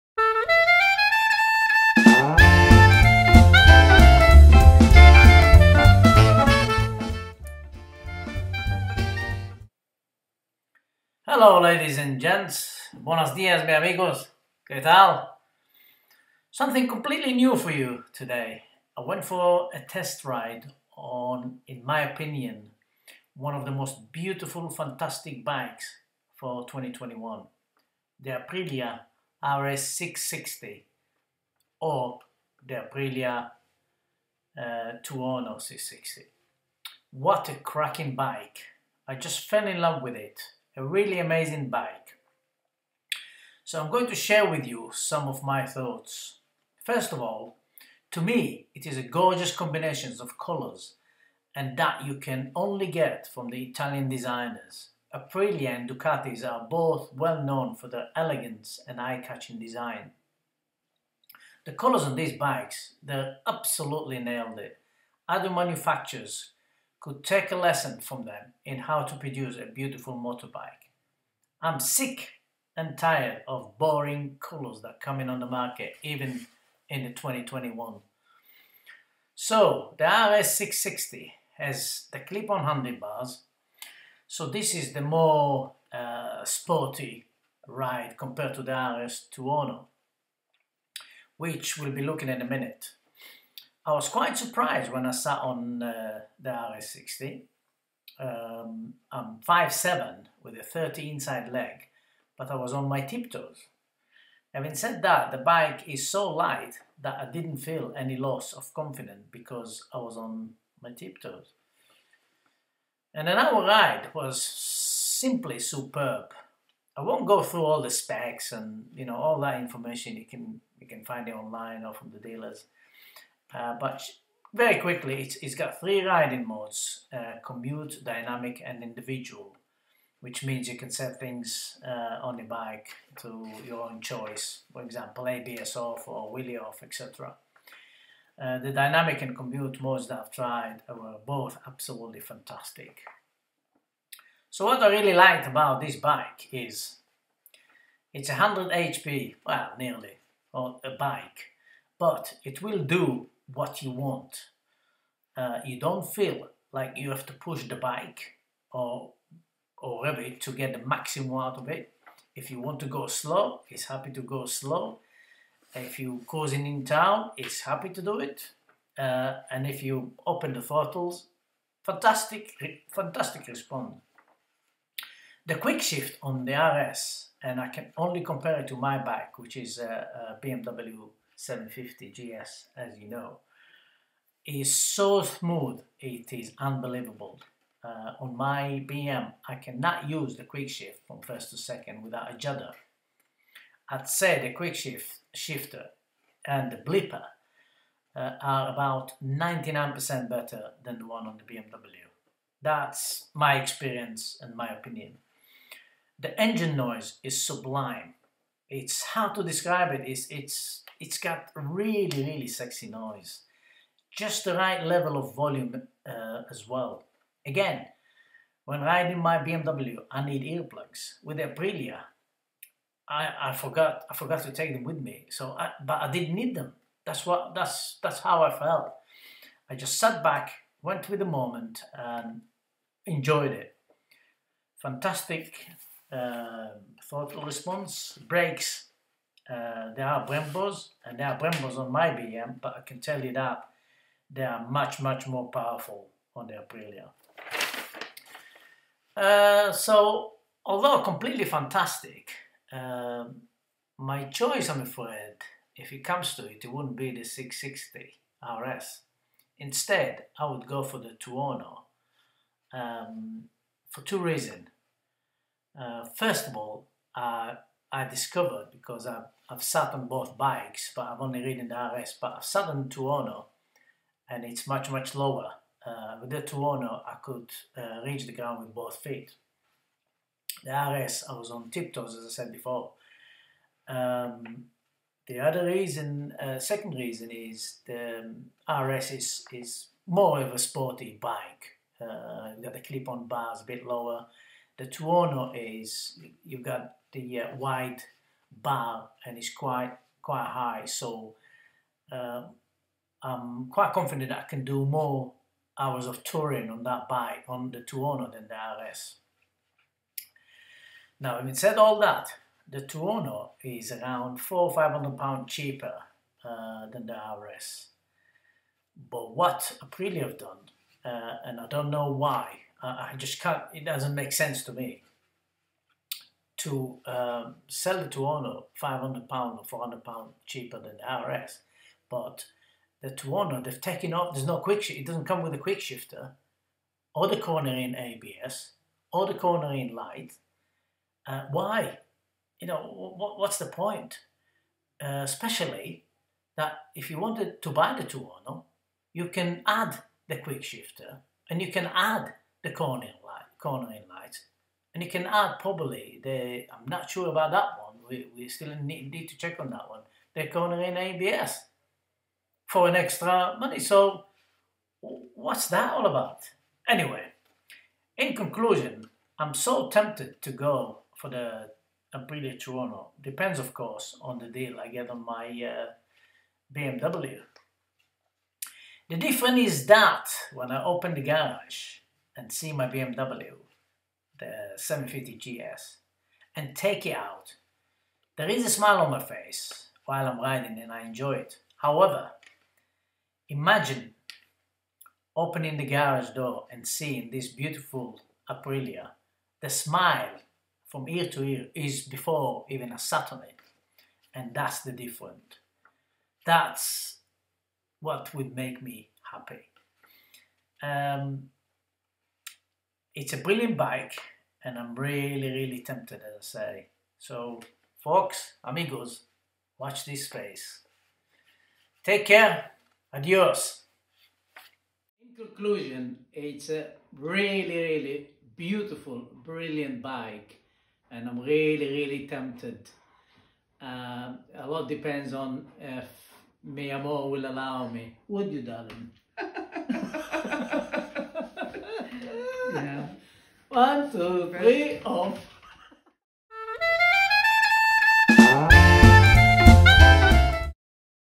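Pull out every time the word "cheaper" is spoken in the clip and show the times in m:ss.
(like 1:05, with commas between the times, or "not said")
5:15, 5:30.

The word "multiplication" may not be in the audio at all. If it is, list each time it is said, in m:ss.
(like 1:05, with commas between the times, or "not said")
not said.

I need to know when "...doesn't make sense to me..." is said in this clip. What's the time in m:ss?
5:23.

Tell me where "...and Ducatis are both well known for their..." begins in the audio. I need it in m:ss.
0:55.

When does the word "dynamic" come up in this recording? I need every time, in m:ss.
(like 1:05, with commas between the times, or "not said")
2:08, 2:18.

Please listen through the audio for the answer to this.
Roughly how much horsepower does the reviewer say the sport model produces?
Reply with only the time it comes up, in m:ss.
2:28.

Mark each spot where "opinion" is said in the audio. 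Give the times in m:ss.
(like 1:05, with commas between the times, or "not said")
0:22, 3:24.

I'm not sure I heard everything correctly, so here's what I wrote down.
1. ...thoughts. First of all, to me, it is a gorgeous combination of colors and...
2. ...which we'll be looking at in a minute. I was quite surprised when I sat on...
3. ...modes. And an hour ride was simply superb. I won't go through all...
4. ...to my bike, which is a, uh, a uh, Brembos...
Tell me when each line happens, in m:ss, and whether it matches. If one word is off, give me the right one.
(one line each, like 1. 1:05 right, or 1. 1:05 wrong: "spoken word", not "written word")
1. 0:45 right
2. 1:31 right
3. 1:50 wrong: "tiptoes", not "modes"
4. 2:58 wrong: "BMW", not "Brembos".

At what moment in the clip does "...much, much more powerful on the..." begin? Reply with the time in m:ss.
4:04.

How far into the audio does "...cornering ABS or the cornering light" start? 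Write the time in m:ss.
5:37.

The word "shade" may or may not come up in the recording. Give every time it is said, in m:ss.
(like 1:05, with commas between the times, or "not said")
not said.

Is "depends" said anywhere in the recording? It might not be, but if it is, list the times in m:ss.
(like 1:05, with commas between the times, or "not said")
6:13, 7:14.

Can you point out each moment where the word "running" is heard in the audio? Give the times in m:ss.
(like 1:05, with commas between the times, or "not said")
not said.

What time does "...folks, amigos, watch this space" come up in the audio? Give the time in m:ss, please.
6:57.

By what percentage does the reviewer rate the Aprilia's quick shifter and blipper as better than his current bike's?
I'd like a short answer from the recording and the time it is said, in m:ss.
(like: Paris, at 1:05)
99%, at 3:19.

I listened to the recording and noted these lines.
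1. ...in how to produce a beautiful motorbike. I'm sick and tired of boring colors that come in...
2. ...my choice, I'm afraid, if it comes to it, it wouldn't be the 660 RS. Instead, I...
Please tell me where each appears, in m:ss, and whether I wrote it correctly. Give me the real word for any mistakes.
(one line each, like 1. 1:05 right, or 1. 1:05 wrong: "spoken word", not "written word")
1. 1:08 right
2. 4:13 right.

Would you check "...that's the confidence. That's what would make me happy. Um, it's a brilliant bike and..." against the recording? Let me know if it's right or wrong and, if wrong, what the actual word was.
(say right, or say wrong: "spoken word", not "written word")
wrong: "difference", not "confidence".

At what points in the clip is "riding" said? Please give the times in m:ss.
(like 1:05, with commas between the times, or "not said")
2:06, 3:38, 6:30.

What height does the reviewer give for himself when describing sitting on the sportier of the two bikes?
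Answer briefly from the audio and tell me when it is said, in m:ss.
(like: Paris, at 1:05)
5'7, at 1:39.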